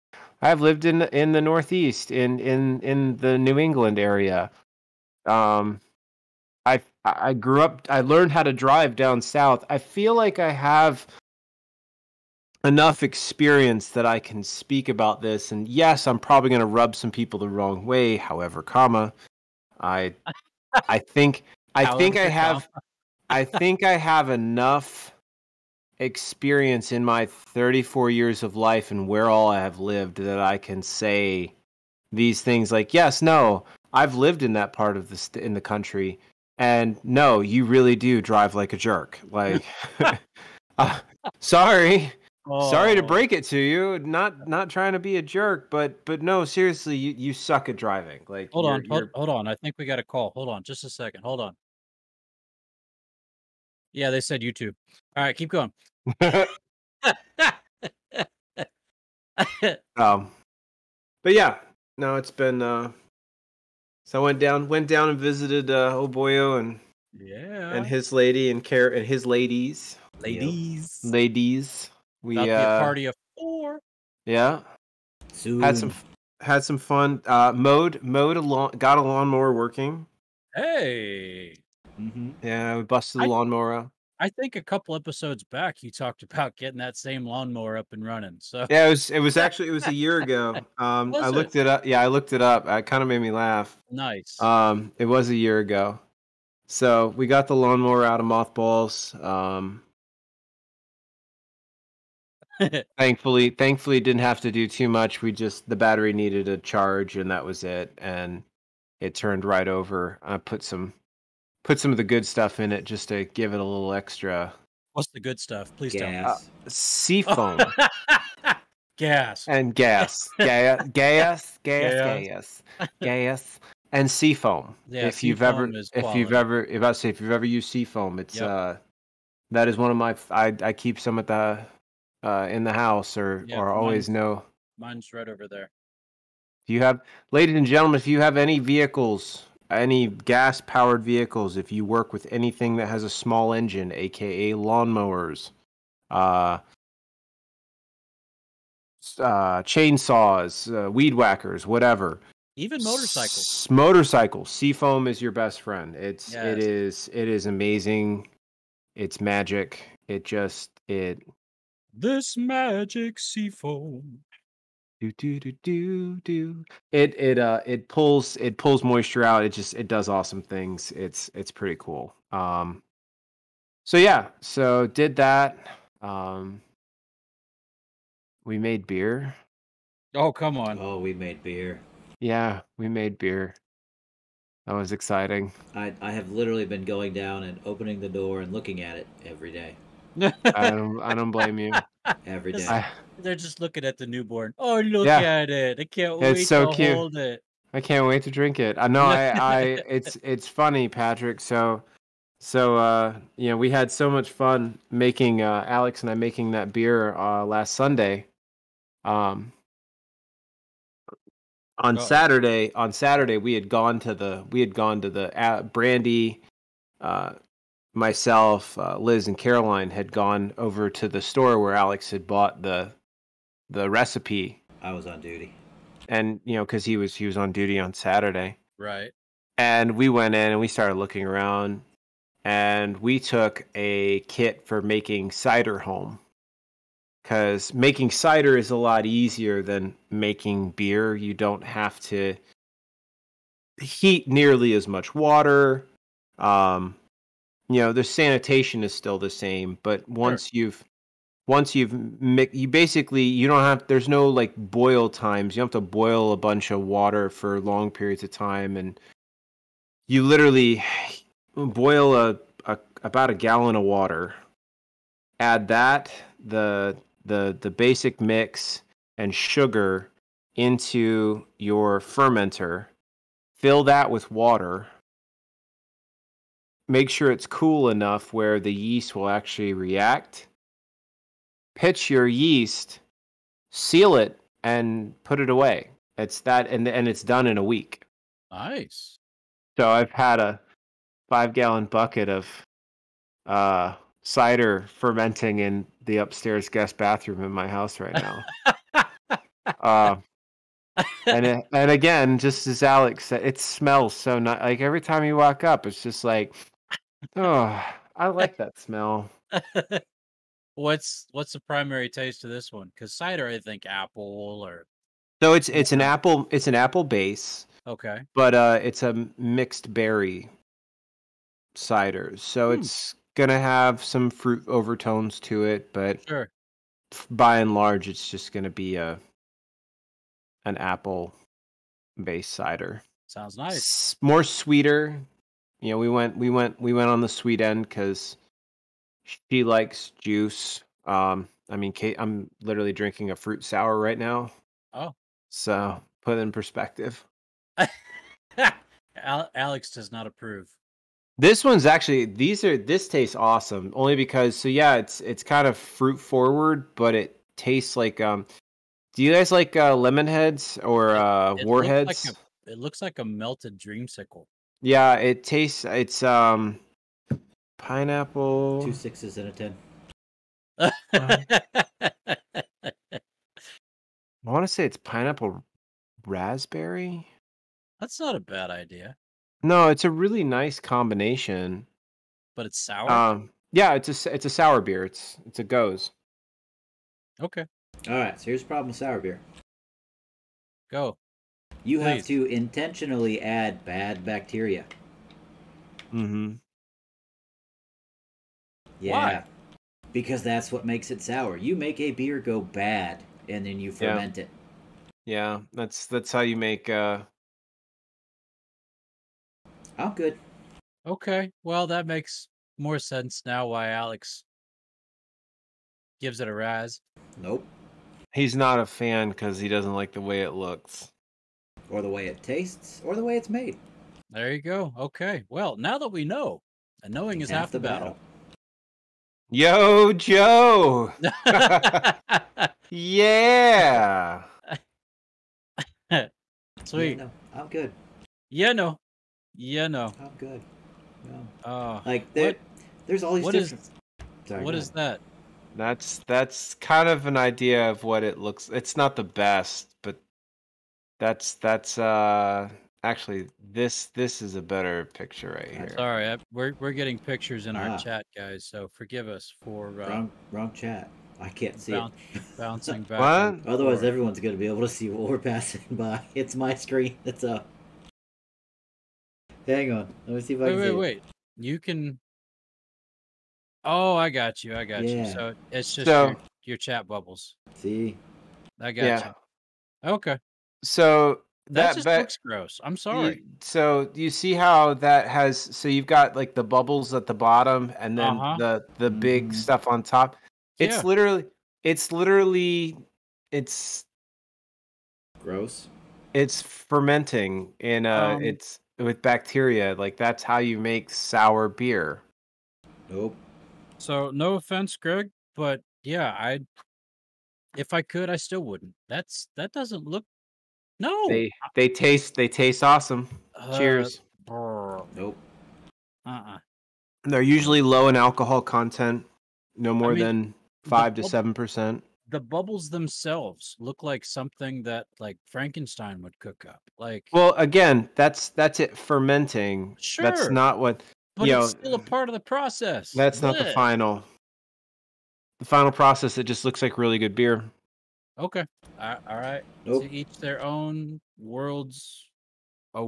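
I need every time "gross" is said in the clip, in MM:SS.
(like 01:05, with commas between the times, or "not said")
08:02, 08:15.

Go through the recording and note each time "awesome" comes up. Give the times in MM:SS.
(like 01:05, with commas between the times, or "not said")
02:50, 05:53, 08:32.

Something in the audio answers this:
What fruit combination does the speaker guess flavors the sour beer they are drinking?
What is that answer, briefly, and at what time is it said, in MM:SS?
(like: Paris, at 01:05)
Pineapple raspberry, at 06:14.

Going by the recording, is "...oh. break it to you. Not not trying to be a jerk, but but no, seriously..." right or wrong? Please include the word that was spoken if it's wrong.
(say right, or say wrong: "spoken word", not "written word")
right.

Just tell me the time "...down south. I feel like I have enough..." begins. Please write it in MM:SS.
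00:08.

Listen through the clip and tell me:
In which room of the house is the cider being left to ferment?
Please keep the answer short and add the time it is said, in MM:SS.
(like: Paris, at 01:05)
Upstairs guest bathroom, at 04:56.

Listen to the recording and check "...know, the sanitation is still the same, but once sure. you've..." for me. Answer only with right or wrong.
right.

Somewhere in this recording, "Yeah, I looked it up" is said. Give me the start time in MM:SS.
01:31.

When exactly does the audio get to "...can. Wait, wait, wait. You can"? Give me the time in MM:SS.
07:50.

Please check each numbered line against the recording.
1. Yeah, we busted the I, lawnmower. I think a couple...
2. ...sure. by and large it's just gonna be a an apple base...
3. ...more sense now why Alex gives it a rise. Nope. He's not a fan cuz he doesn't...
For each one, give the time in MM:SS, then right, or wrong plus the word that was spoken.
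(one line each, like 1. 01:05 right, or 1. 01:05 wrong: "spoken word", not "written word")
1. 01:22 right
2. 05:26 right
3. 06:52 right.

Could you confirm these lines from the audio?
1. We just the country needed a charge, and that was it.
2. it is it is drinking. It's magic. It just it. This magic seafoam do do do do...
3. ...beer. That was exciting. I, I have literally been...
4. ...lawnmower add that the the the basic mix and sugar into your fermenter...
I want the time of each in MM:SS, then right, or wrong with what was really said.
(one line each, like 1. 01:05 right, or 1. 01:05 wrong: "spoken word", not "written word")
1. 01:45 wrong: "battery", not "country"
2. 02:36 wrong: "amazing", not "drinking"
3. 03:03 right
4. 04:23 wrong: "water", not "lawnmower".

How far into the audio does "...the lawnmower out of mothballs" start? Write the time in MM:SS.
01:37.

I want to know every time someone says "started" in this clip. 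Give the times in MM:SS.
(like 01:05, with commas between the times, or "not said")
03:50.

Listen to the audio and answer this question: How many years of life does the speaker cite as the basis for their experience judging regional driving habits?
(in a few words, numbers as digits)
34.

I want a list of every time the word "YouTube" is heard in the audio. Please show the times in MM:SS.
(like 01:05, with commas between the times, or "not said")
00:54.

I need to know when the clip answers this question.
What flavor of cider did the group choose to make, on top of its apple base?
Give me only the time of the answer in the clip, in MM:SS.
05:19.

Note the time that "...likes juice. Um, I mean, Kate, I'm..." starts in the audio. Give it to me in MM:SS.
05:39.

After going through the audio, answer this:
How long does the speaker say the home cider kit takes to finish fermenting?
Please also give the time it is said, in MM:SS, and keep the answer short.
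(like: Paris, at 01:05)
A week, at 04:47.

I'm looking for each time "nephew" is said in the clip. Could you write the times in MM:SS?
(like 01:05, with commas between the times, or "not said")
not said.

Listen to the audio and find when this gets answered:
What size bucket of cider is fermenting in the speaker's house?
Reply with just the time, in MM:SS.
04:51.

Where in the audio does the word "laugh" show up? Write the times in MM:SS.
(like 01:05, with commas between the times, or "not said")
01:33.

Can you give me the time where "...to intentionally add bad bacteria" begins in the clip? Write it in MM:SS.
06:32.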